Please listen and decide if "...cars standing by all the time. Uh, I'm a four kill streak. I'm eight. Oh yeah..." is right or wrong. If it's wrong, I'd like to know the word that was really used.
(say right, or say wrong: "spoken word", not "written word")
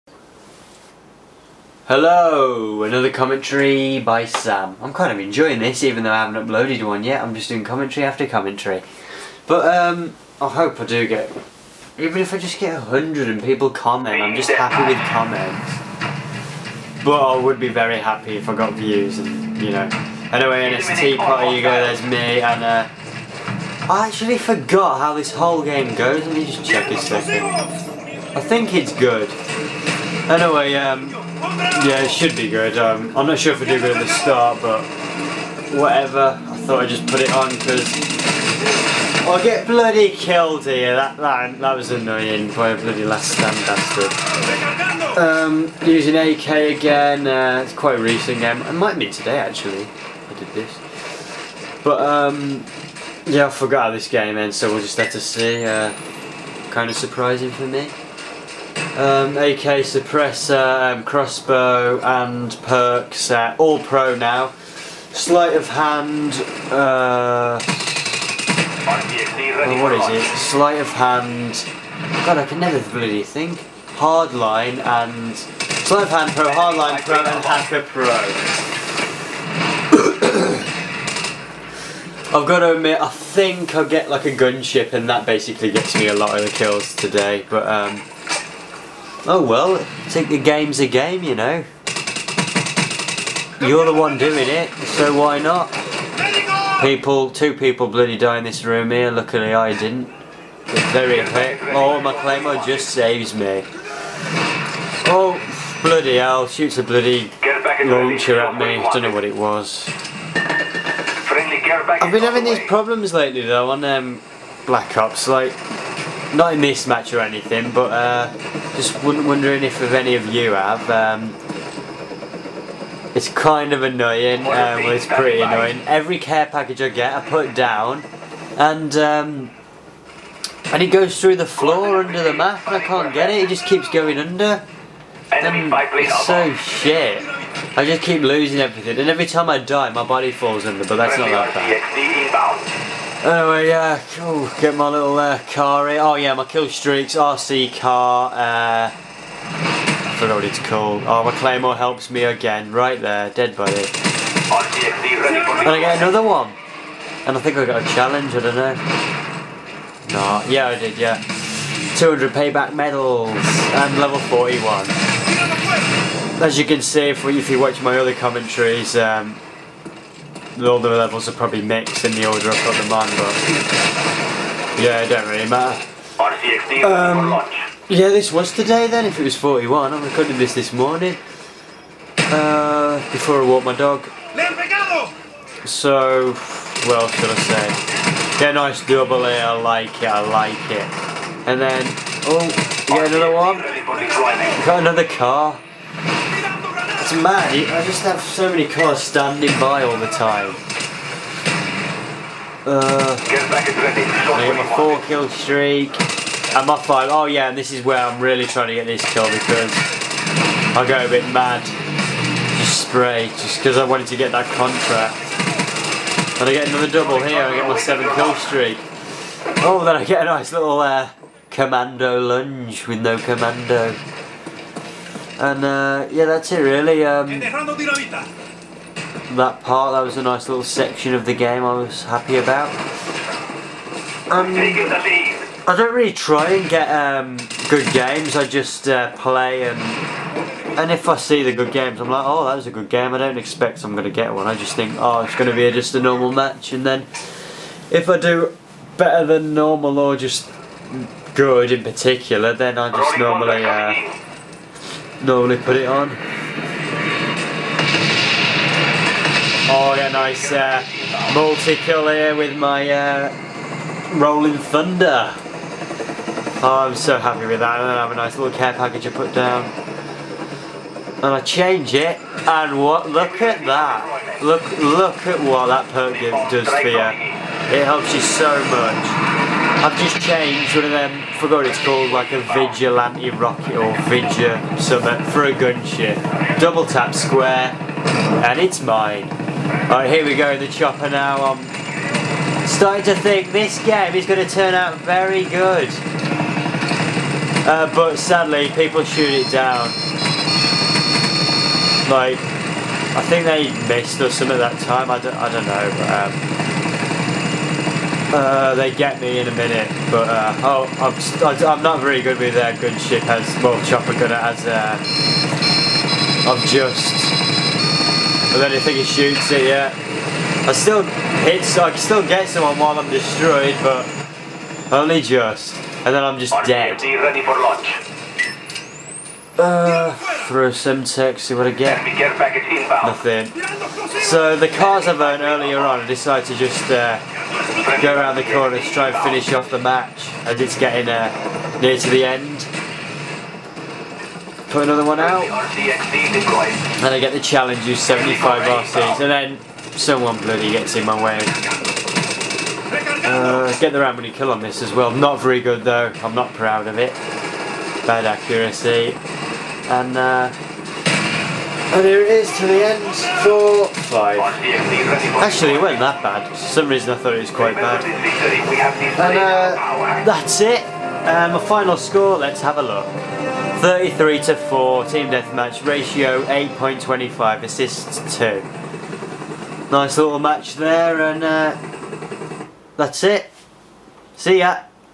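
wrong: "five", not "eight".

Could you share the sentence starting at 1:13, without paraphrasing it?
Hardline and, sleight of hand pro, hardline pro and hacker pro.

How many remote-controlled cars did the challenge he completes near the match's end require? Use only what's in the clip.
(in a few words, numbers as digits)
75.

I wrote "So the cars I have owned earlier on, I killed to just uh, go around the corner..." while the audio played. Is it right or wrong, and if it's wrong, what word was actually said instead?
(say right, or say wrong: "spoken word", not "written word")
wrong: "decided", not "killed".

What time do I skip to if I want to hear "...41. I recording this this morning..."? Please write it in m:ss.
2:59.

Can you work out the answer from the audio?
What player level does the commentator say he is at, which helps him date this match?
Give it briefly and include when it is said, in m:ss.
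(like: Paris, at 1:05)
41, at 2:43.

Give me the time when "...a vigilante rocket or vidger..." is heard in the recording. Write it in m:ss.
4:42.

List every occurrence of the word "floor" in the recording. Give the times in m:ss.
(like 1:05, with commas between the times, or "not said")
2:11.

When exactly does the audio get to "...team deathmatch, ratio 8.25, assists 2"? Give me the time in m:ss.
6:15.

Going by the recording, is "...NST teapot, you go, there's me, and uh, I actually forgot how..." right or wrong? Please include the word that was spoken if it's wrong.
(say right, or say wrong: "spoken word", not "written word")
right.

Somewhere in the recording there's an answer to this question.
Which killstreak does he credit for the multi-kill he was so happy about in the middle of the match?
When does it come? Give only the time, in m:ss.
4:24.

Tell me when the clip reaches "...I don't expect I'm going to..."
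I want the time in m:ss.
4:03.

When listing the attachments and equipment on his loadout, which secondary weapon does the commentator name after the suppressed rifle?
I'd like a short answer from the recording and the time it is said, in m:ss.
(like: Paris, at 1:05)
Crossbow, at 1:01.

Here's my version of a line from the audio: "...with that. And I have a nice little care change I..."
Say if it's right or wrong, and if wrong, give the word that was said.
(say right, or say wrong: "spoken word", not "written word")
wrong: "package", not "change".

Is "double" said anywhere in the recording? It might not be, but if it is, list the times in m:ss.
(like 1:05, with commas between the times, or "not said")
3:08, 3:36, 4:46.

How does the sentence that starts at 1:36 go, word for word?
People, two people bloody die in this room here, luckily I didn't.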